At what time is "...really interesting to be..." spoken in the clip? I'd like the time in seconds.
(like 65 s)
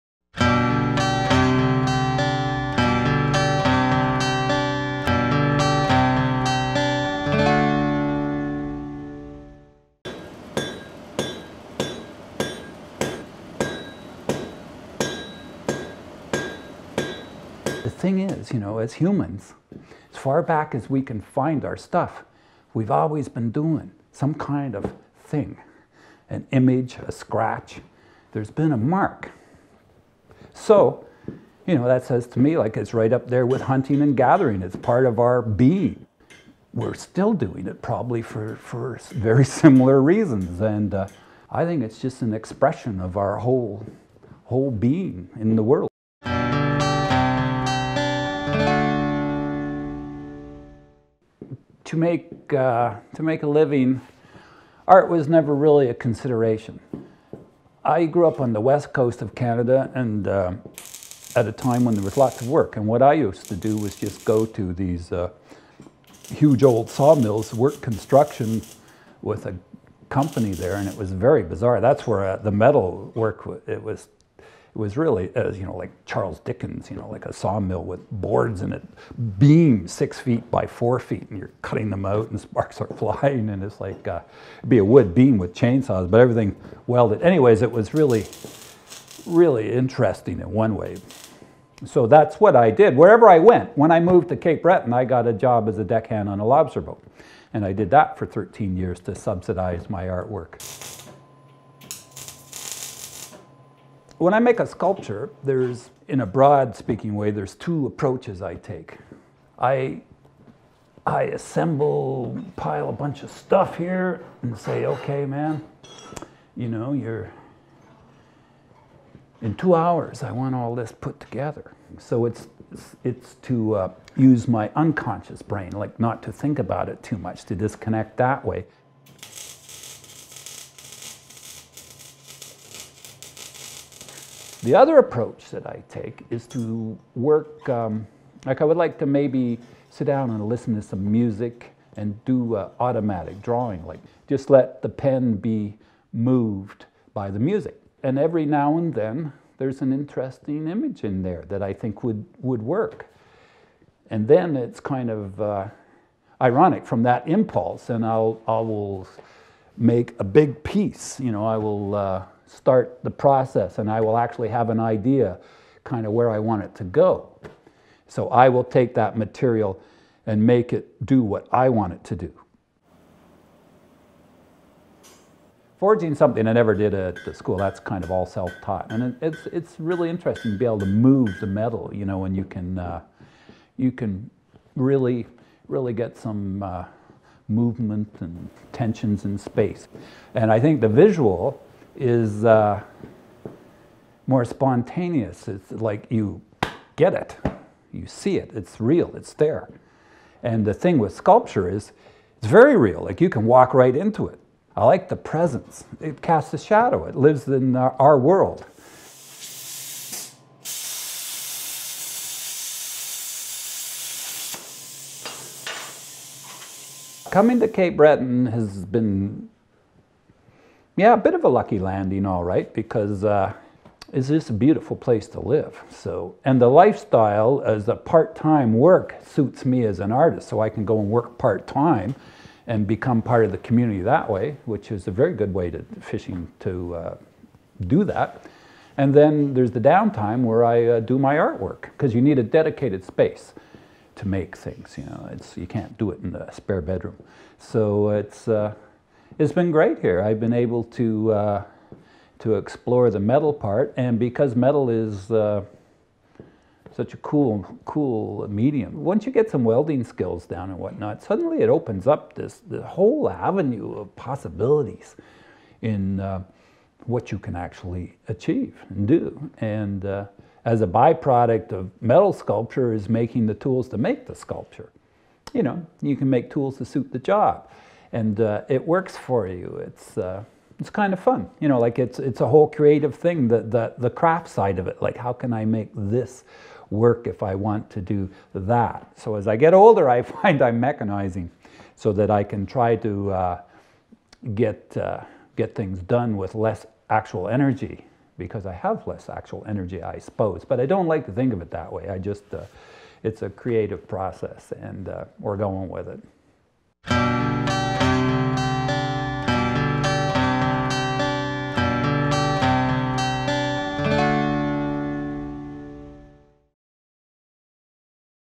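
179 s.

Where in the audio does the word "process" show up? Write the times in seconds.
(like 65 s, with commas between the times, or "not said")
163 s, 304 s.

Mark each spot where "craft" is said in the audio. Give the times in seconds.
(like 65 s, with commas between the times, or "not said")
284 s.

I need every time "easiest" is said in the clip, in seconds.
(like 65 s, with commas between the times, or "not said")
not said.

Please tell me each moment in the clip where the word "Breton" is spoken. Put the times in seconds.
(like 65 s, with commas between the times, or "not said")
94 s, 217 s.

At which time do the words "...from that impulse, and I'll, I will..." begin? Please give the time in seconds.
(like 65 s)
156 s.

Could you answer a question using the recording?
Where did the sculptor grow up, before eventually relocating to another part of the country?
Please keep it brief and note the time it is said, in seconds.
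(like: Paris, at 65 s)
West coast of Canada, at 58 s.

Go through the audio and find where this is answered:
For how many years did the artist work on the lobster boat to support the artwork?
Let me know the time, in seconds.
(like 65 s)
98 s.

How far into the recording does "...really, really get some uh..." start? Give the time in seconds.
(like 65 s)
184 s.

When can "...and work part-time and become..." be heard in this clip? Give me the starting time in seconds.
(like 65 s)
230 s.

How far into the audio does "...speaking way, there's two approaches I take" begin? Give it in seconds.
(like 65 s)
106 s.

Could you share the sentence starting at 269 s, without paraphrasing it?
And uh, as a byproduct of metal sculpture is making the tools to make the sculpture.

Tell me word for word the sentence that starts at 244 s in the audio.
You know, it's you can't do it in the spare bedroom.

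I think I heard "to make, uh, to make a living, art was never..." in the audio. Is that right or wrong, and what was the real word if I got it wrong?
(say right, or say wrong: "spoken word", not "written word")
right.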